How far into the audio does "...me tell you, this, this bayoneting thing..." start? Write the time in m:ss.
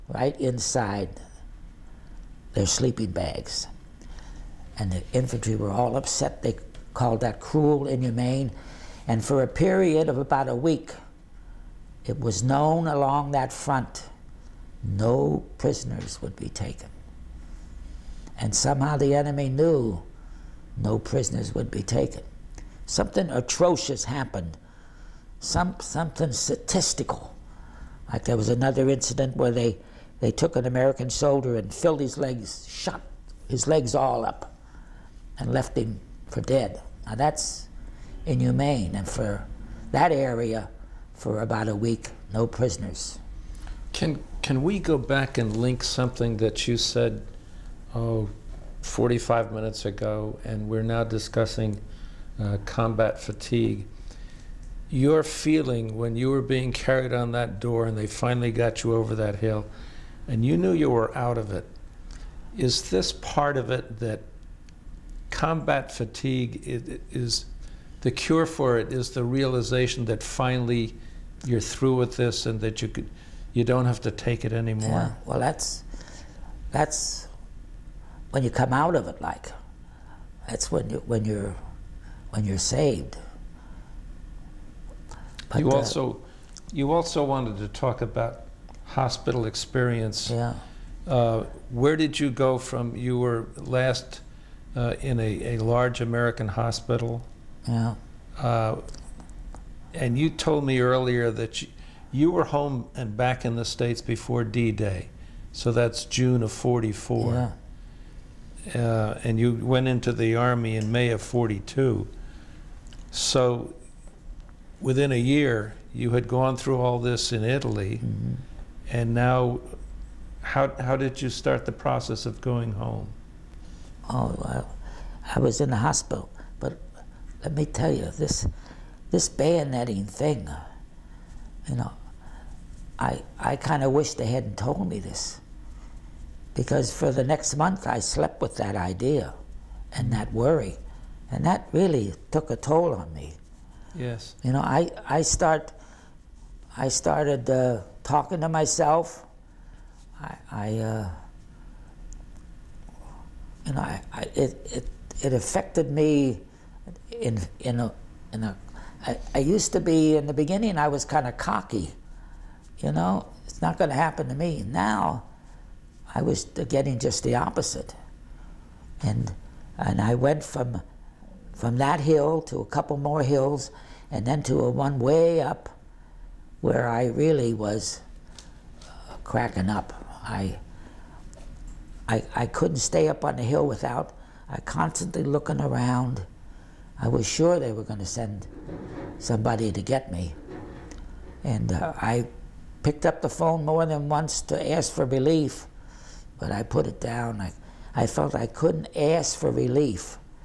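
2:07.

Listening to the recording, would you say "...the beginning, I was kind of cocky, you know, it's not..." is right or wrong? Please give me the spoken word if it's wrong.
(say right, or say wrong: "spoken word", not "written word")
right.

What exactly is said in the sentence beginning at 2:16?
Because for the next month, I slept with that idea and that worry.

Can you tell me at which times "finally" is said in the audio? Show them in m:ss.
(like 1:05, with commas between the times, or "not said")
0:58, 1:10.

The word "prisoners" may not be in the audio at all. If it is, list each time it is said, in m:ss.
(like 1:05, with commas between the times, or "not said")
0:15, 0:20, 0:42.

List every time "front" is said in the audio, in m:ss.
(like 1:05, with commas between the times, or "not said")
0:13.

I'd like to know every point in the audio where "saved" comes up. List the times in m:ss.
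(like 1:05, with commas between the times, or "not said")
1:22.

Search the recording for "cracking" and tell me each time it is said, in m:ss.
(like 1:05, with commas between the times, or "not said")
2:59.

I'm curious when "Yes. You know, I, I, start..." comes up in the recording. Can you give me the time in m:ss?
2:23.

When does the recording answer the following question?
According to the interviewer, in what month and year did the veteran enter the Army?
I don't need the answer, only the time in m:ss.
1:50.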